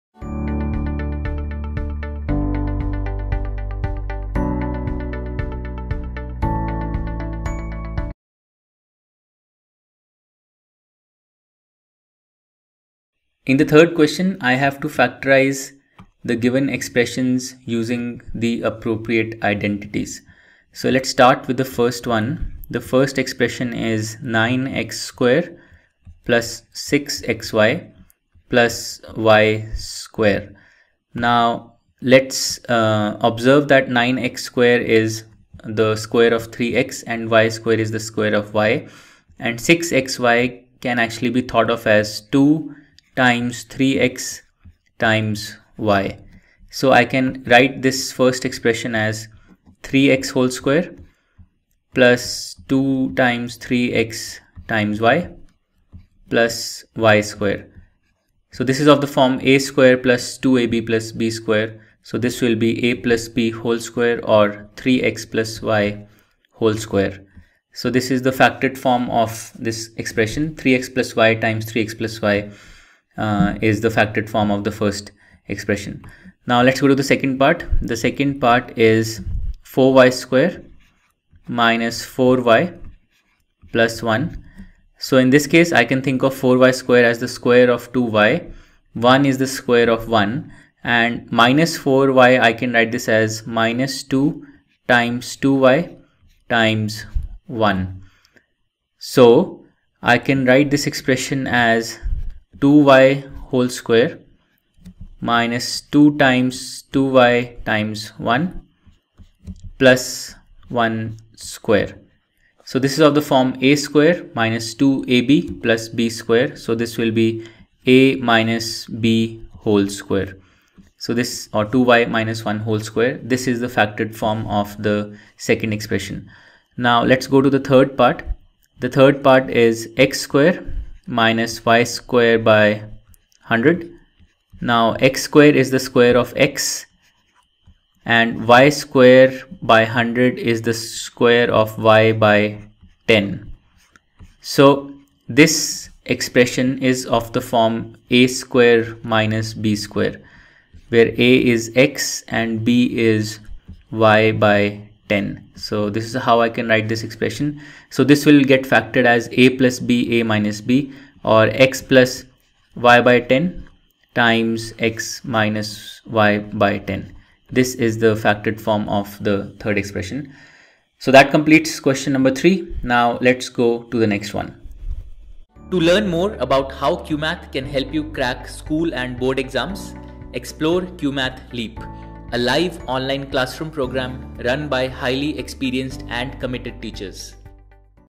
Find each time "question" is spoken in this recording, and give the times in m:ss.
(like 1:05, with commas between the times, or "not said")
0:13, 2:51.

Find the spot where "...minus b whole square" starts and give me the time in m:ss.
1:58.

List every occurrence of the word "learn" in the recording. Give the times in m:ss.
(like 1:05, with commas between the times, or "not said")
2:55.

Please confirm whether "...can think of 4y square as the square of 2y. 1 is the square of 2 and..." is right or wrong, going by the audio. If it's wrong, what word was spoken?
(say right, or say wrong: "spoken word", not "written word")
wrong: "1", not "2".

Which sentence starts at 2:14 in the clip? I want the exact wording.
Now x square is the square of x and y square by 100 is the square of y by 10.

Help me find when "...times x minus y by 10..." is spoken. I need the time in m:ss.
2:44.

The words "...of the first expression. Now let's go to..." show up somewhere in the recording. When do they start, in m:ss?
1:14.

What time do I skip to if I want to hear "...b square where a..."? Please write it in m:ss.
2:29.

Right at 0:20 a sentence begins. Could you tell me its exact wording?
So let's start with the first one.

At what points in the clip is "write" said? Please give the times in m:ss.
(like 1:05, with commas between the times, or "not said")
0:47, 1:32, 1:40, 2:36.